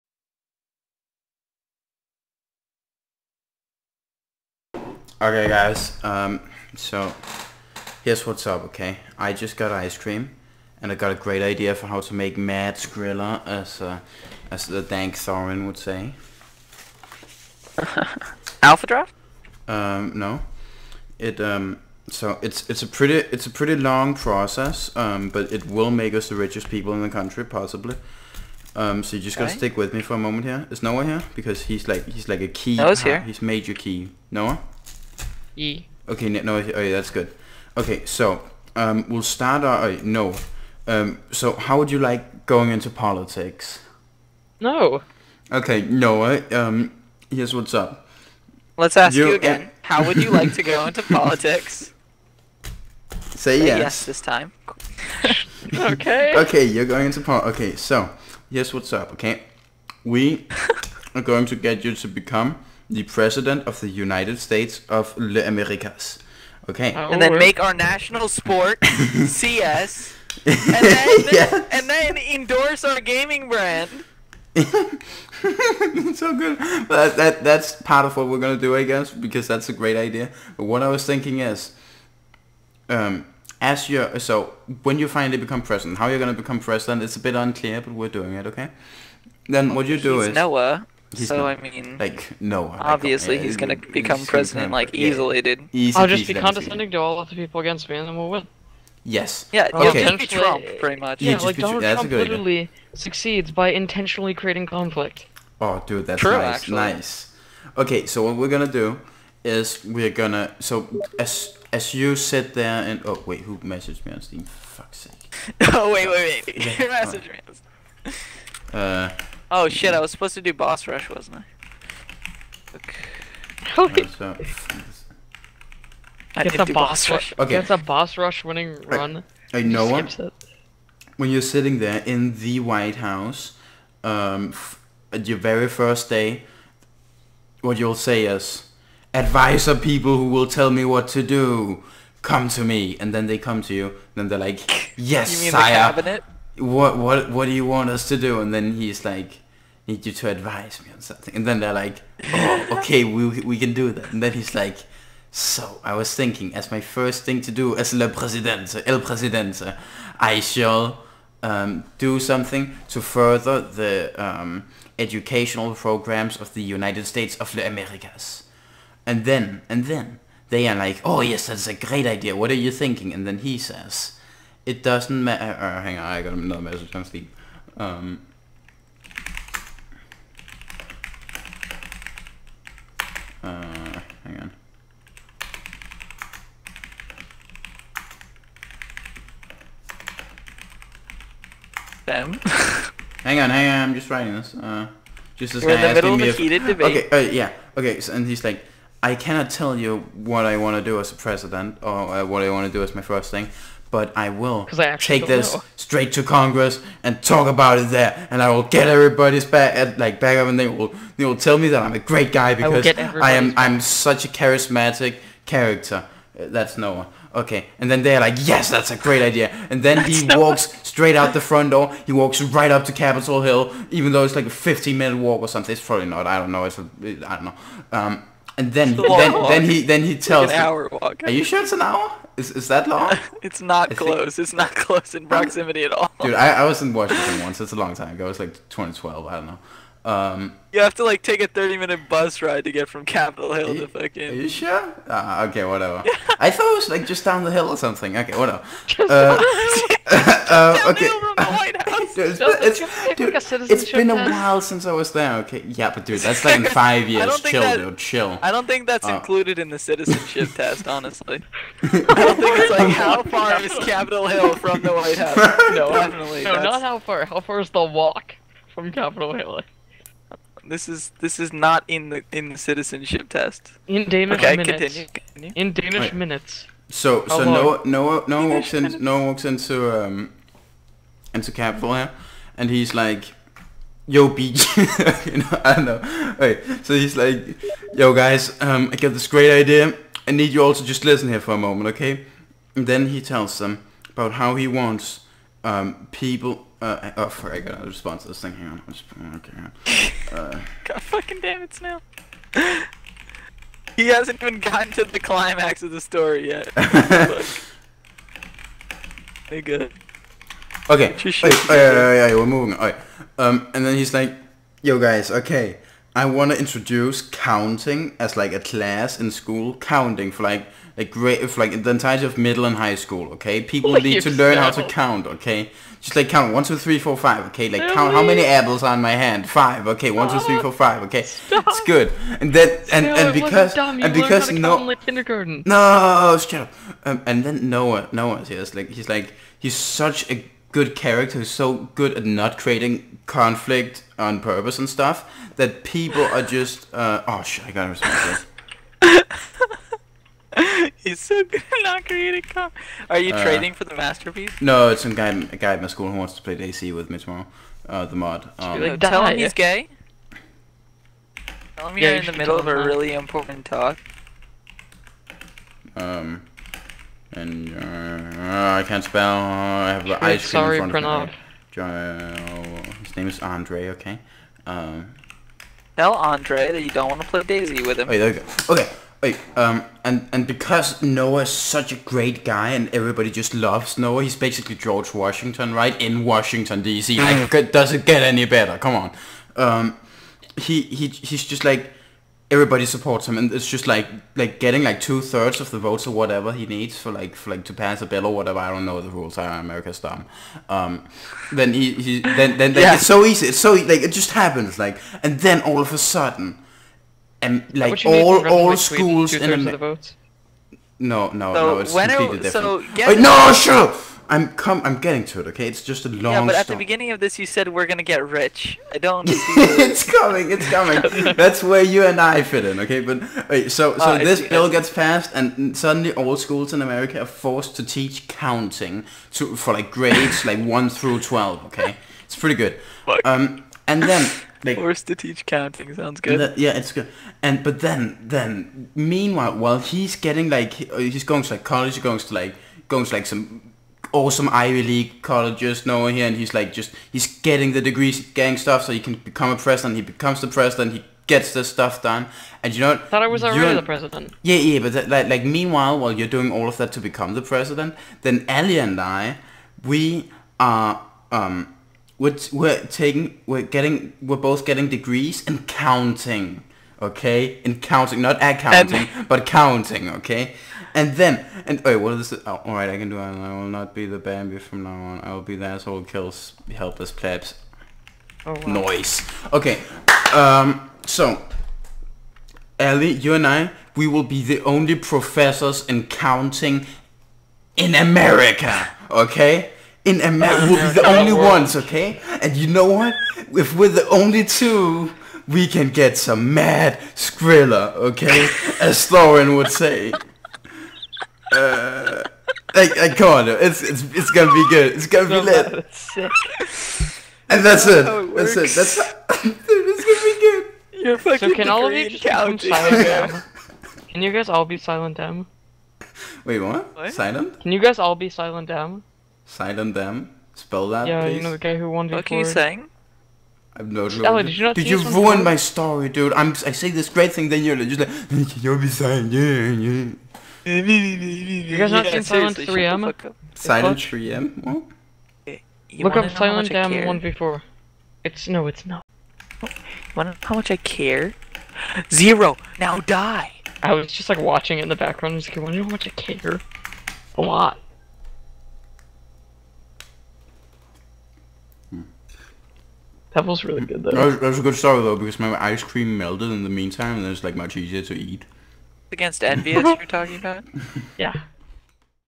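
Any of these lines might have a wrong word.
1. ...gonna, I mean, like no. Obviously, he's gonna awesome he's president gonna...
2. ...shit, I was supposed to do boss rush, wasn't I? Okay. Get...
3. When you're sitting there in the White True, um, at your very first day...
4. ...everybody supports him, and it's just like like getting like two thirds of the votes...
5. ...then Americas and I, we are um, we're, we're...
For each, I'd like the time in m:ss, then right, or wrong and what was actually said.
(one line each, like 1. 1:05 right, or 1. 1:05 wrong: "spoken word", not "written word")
1. 1:31 wrong: "become", not "awesome"
2. 1:59 right
3. 2:11 wrong: "House", not "True"
4. 6:32 right
5. 7:38 wrong: "Ellie", not "Americas".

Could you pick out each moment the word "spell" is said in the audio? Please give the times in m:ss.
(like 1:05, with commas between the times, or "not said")
6:09, 8:40.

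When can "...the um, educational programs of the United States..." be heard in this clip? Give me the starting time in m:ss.
2:43.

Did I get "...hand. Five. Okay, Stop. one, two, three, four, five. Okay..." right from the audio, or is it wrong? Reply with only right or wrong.
right.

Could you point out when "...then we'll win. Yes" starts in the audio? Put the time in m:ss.
1:38.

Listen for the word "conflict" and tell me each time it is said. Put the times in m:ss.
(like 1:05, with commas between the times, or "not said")
1:44, 5:43, 5:52.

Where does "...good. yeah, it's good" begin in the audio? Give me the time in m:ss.
7:16.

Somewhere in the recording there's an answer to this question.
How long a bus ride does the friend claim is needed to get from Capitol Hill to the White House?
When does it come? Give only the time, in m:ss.
4:01.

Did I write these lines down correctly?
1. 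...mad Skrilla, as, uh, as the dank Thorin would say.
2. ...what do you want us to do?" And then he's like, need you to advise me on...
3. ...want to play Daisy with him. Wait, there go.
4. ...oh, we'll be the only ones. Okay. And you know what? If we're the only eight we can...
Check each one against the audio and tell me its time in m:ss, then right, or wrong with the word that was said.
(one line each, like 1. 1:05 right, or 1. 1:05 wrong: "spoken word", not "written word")
1. 0:12 right
2. 2:27 right
3. 6:17 right
4. 8:10 wrong: "two", not "eight".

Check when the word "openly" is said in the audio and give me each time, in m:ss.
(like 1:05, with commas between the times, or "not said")
not said.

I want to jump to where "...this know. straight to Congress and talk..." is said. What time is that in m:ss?
3:25.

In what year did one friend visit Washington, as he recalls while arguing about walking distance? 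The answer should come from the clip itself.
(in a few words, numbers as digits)
2012.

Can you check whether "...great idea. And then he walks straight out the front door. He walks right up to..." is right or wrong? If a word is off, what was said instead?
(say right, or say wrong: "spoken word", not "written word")
right.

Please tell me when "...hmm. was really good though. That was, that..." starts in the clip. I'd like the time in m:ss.
9:13.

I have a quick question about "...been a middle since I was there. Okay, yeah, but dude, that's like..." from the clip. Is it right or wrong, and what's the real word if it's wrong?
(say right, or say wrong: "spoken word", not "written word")
wrong: "while", not "middle".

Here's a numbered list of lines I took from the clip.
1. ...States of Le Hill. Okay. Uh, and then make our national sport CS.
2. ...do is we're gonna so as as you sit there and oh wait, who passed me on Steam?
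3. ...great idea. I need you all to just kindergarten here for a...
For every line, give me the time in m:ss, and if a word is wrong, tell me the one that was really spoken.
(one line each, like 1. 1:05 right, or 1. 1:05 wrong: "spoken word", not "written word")
1. 1:04 wrong: "Americas", not "Hill"
2. 1:48 wrong: "messaged", not "passed"
3. 4:49 wrong: "listen", not "kindergarten".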